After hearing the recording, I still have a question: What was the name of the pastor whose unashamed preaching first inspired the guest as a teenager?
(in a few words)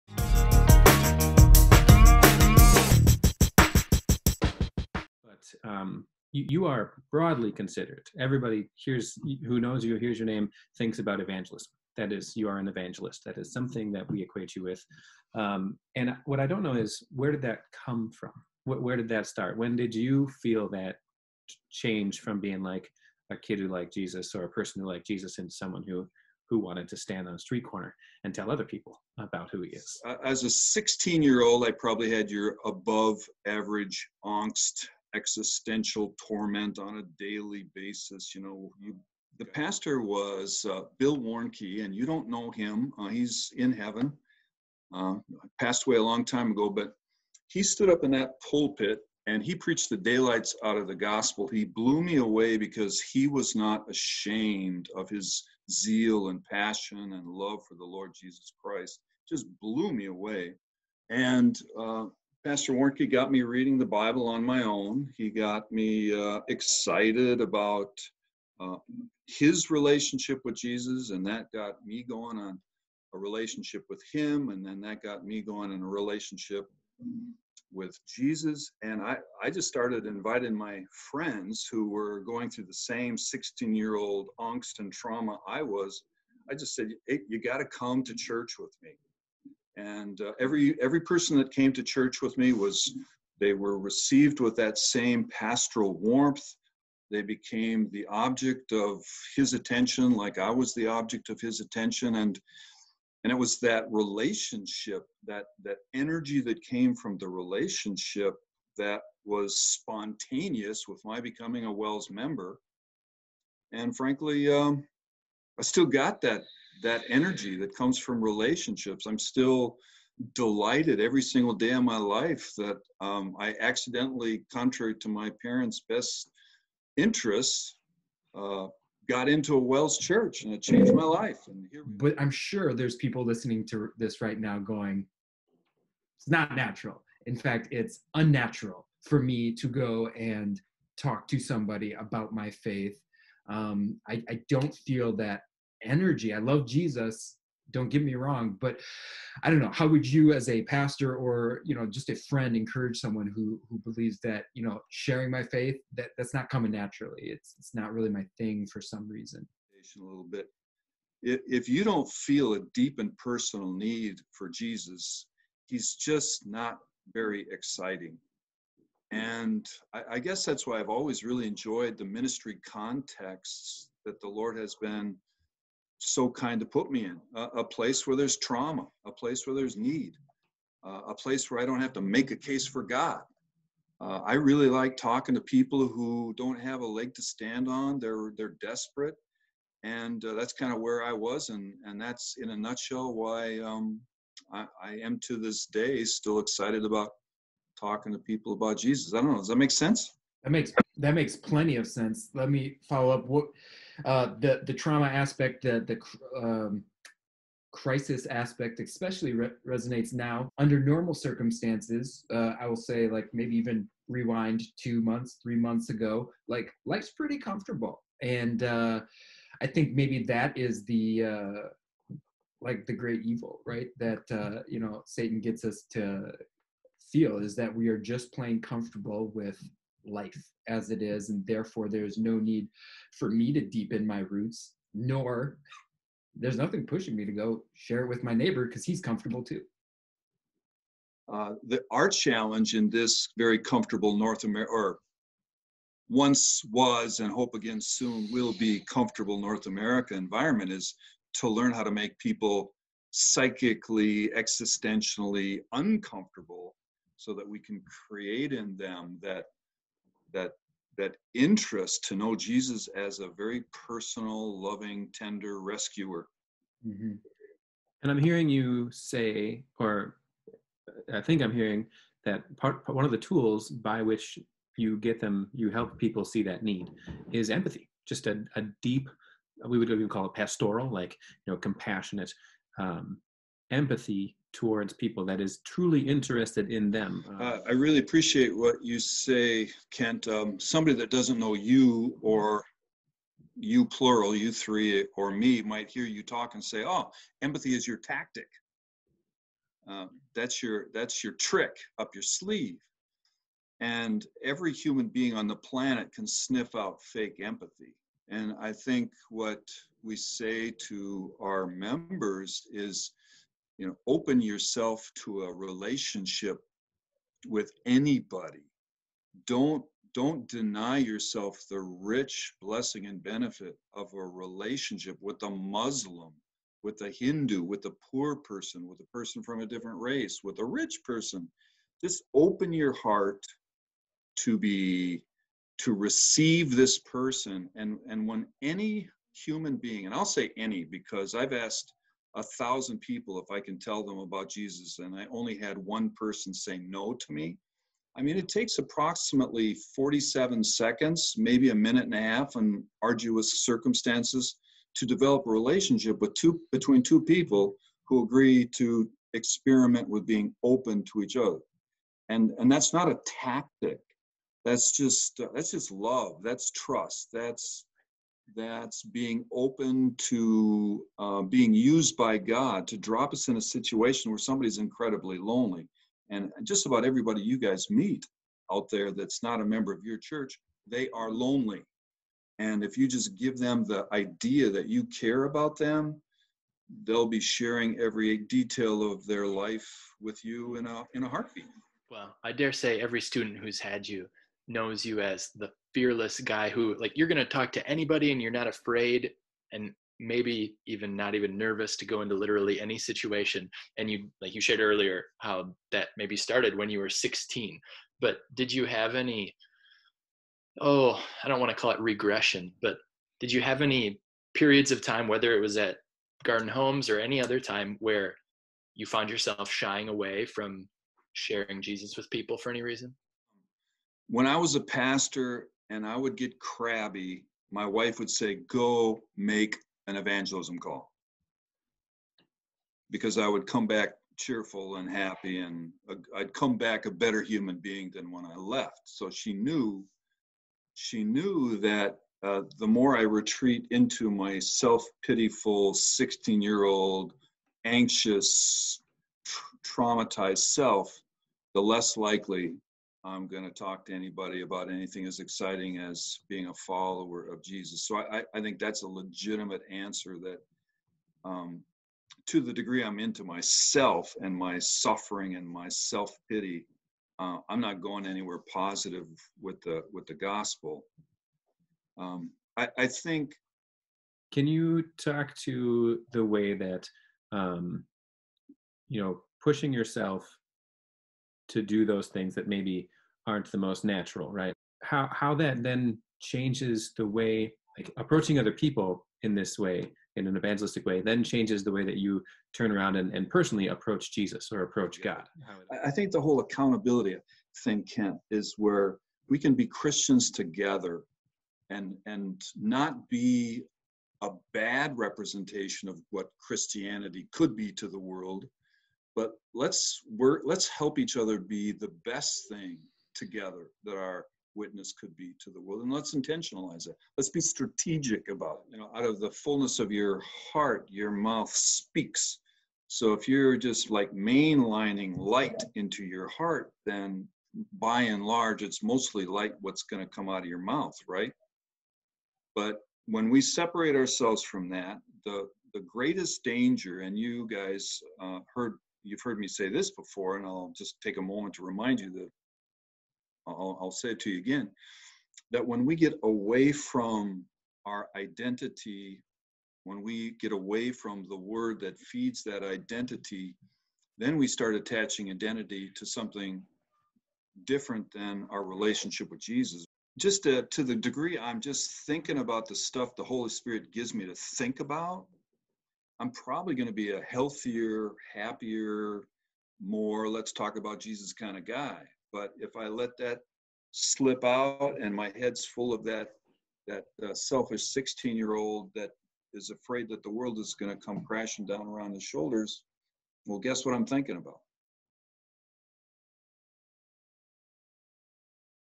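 Bill Warnke.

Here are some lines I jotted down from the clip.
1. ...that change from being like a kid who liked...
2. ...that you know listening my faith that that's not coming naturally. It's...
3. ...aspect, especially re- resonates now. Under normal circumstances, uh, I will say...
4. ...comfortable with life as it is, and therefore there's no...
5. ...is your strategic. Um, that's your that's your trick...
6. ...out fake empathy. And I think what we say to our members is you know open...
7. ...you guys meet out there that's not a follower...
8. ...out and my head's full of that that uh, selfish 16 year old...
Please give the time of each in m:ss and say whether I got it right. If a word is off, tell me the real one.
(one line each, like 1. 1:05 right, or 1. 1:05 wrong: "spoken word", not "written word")
1. 0:20 right
2. 2:34 wrong: "sharing", not "listening"
3. 3:28 right
4. 3:48 right
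5. 4:57 wrong: "tactic", not "strategic"
6. 5:06 right
7. 6:17 wrong: "member", not "follower"
8. 9:34 right.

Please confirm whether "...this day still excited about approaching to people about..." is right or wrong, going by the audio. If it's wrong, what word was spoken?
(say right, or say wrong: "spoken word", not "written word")
wrong: "talking", not "approaching".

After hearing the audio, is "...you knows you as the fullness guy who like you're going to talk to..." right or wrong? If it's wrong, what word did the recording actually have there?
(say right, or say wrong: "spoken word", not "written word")
wrong: "fearless", not "fullness".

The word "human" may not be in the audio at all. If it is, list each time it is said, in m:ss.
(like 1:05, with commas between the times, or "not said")
5:04, 5:39, 7:17.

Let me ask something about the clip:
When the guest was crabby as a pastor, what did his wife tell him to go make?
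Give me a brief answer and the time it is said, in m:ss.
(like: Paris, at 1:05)
An evangelism call, at 7:10.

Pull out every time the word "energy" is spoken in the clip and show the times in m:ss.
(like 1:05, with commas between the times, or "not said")
1:45, 1:57, 2:25.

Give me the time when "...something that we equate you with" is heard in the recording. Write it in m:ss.
0:13.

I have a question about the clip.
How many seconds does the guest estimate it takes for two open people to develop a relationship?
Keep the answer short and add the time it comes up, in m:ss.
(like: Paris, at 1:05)
47 seconds, at 5:49.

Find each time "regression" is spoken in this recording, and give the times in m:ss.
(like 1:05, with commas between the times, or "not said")
6:51.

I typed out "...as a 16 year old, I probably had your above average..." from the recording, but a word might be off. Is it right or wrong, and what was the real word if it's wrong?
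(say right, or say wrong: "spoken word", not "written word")
right.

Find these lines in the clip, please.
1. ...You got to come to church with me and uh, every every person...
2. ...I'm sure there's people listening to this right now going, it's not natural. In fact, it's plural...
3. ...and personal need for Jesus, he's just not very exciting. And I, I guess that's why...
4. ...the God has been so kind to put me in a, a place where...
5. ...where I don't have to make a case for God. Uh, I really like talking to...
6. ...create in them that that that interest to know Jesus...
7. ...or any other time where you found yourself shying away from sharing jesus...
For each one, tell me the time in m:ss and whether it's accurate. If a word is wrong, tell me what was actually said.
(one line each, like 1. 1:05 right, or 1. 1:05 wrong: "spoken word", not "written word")
1. 1:27 right
2. 2:12 wrong: "unnatural", not "plural"
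3. 2:42 right
4. 2:54 wrong: "Lord", not "God"
5. 3:01 right
6. 4:18 right
7. 6:57 right.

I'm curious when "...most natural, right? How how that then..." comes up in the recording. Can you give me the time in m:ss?
8:03.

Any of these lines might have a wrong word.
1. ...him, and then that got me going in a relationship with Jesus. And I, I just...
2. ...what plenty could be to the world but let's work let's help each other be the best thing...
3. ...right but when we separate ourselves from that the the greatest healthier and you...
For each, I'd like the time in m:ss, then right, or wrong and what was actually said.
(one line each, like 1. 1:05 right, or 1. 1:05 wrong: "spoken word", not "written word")
1. 1:14 right
2. 8:26 wrong: "christianity", not "plenty"
3. 8:51 wrong: "danger", not "healthier".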